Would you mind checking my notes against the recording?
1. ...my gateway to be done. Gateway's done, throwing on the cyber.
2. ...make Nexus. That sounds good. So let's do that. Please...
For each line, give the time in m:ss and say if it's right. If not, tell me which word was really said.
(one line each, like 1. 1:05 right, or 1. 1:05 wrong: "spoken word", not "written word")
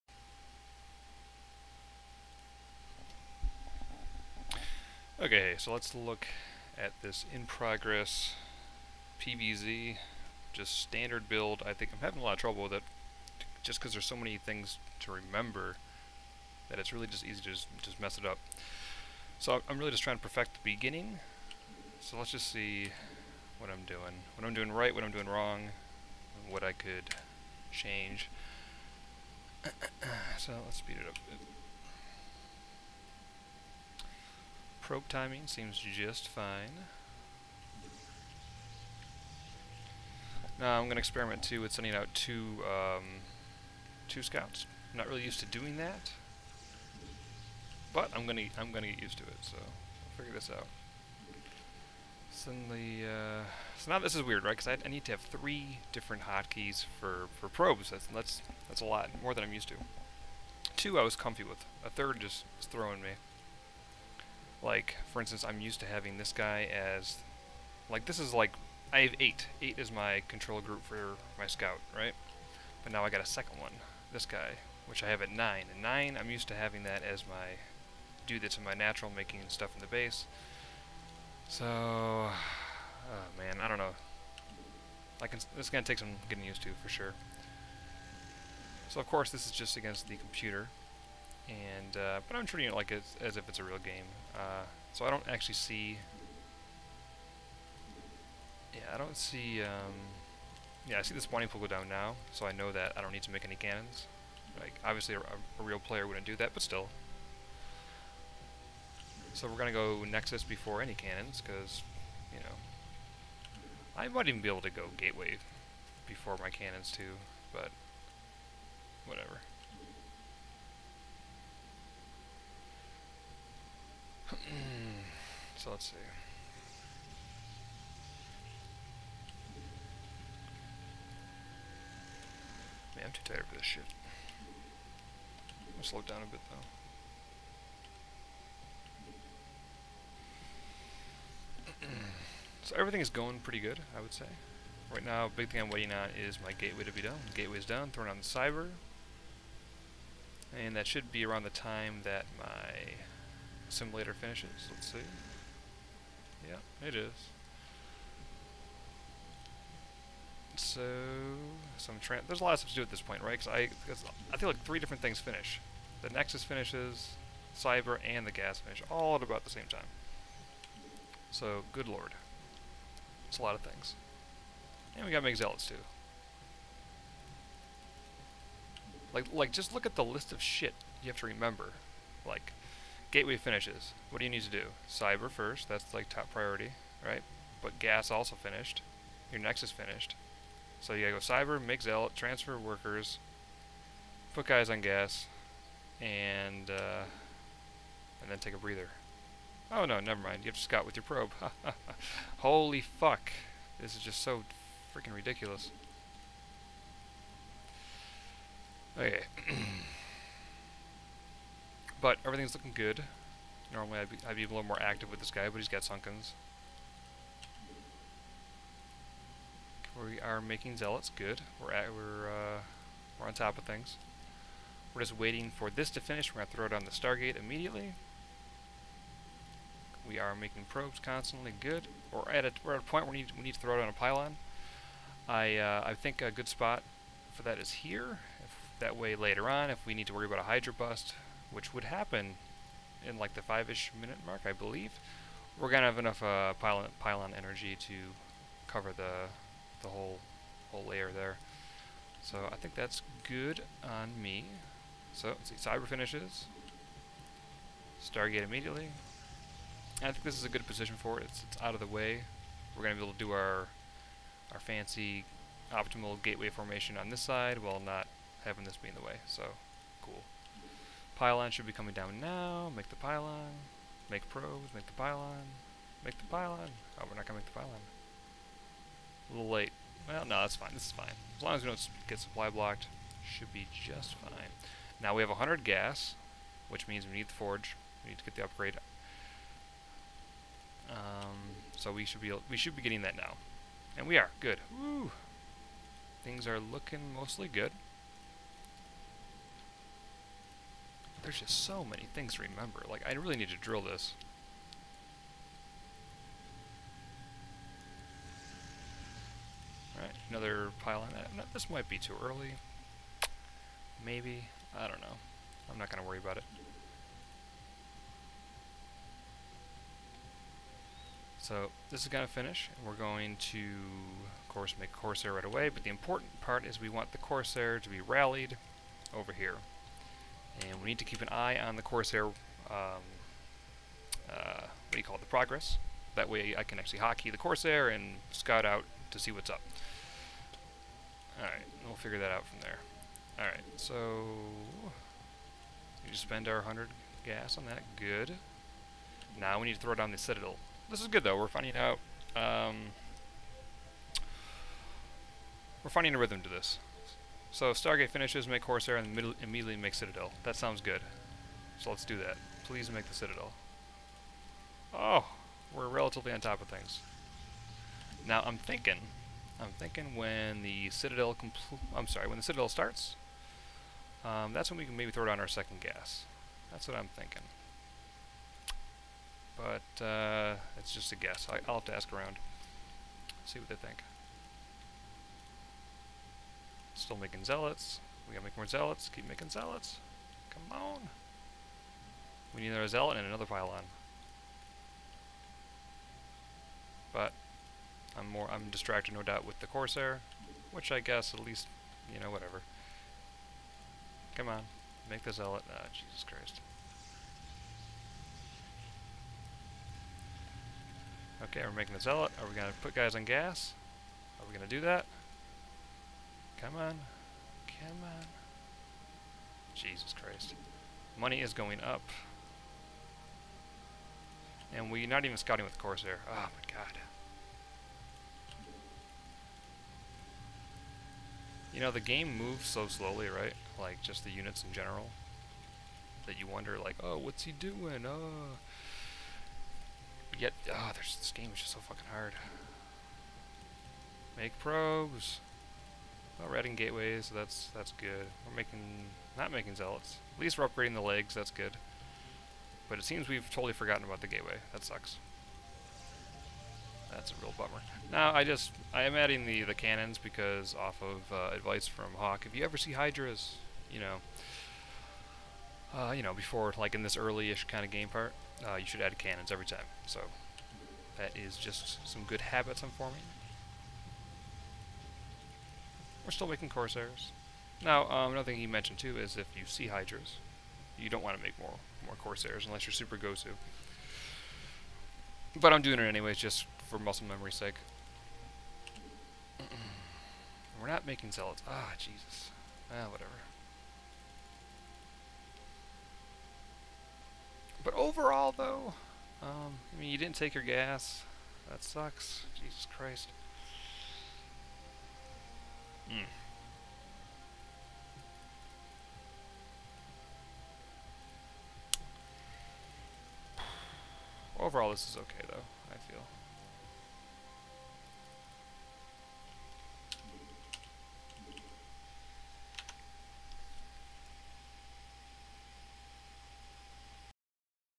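1. 2:26 right
2. 5:59 wrong: "Citadel", not "Nexus".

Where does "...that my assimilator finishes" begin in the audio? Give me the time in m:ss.
2:32.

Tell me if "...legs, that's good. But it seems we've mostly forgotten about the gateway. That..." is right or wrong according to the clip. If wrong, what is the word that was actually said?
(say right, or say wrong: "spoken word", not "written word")
wrong: "totally", not "mostly".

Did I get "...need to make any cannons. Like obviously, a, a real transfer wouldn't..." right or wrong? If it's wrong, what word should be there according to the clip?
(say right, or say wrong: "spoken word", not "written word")
wrong: "player", not "transfer".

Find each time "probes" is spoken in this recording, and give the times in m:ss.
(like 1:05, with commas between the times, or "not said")
0:34, 0:57, 3:21, 3:50, 4:34, 7:24.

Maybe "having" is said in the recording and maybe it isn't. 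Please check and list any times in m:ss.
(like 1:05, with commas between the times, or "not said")
0:11, 1:05, 1:16, 4:28.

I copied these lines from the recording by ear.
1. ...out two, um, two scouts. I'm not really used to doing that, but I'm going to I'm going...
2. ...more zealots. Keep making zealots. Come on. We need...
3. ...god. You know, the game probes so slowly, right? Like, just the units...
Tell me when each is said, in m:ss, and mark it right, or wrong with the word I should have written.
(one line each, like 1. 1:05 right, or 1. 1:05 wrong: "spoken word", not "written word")
1. 0:41 right
2. 6:28 right
3. 7:06 wrong: "moves", not "probes".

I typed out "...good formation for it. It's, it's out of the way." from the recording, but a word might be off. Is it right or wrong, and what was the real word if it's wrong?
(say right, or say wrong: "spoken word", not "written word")
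wrong: "position", not "formation".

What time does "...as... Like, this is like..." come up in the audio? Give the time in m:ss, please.
1:06.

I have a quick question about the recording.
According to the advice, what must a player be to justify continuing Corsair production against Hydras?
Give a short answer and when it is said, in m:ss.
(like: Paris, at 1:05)
Super Gosu, at 8:02.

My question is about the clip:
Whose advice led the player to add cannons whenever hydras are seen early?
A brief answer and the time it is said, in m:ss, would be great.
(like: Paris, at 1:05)
Hawk, at 7:42.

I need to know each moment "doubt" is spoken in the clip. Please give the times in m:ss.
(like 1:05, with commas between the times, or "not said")
6:39.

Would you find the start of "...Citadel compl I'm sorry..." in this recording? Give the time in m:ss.
6:10.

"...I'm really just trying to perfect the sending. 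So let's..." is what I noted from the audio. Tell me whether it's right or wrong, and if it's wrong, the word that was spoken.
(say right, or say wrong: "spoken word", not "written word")
wrong: "beginning", not "sending".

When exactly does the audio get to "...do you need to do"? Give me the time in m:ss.
3:04.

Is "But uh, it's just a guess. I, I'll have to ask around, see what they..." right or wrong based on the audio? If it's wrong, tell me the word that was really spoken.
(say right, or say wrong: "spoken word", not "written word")
right.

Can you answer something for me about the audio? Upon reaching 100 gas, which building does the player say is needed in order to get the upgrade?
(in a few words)
Forge.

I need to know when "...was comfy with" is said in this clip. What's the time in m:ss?
1:01.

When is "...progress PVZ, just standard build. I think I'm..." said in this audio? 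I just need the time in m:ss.
0:07.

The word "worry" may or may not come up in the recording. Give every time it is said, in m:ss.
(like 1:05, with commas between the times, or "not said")
4:00, 5:16.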